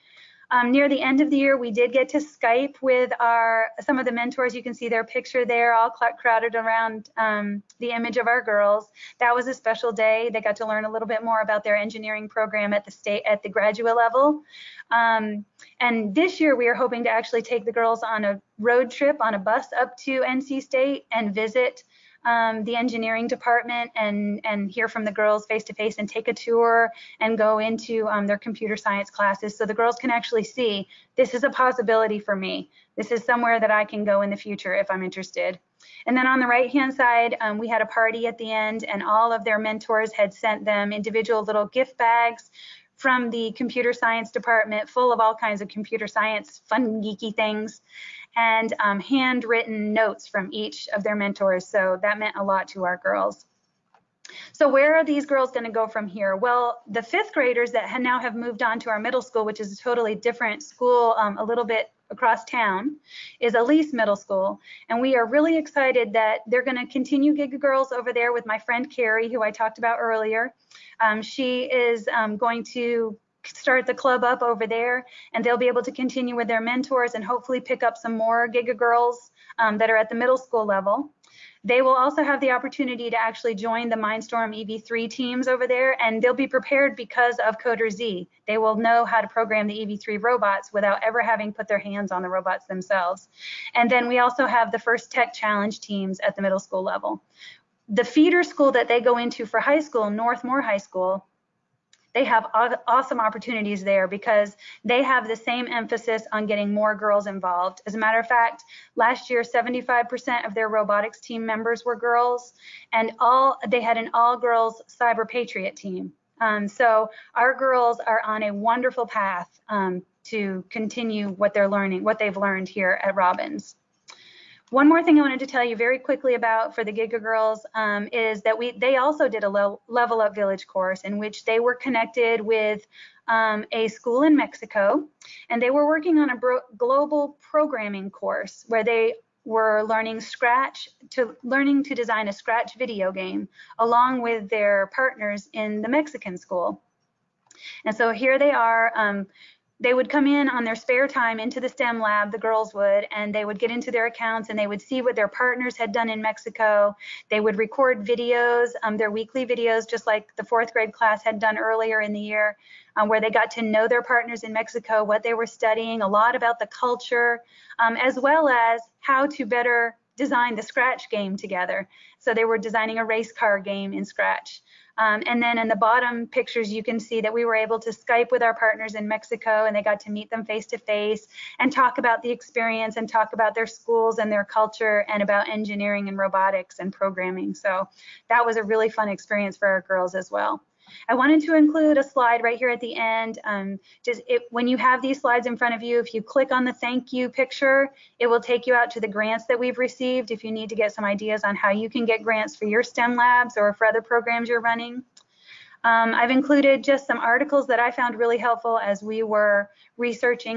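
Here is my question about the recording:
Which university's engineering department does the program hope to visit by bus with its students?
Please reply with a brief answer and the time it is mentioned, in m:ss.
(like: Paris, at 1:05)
NC State, at 0:20.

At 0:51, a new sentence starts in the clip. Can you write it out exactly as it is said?
So that meant a lot to our girls.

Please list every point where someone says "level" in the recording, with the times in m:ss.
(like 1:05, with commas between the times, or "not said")
0:13, 1:20, 1:36, 2:09.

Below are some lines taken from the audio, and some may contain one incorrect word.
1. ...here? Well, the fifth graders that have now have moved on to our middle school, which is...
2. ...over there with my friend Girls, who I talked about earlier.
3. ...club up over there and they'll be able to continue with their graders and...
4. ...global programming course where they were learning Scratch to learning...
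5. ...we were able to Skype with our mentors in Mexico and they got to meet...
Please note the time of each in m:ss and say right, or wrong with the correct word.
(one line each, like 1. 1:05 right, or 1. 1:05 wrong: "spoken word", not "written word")
1. 0:56 right
2. 1:07 wrong: "Carrie", not "Girls"
3. 1:13 wrong: "mentors", not "graders"
4. 2:16 right
5. 2:57 wrong: "partners", not "mentors".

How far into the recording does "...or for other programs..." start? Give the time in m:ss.
3:23.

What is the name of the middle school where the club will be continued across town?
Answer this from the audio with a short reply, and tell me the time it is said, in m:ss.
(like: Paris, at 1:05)
Elise Middle School, at 1:03.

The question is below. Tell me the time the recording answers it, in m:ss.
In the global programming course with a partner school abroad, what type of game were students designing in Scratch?
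2:53.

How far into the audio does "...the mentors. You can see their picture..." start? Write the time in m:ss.
0:04.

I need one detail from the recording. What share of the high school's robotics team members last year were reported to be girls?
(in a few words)
75%.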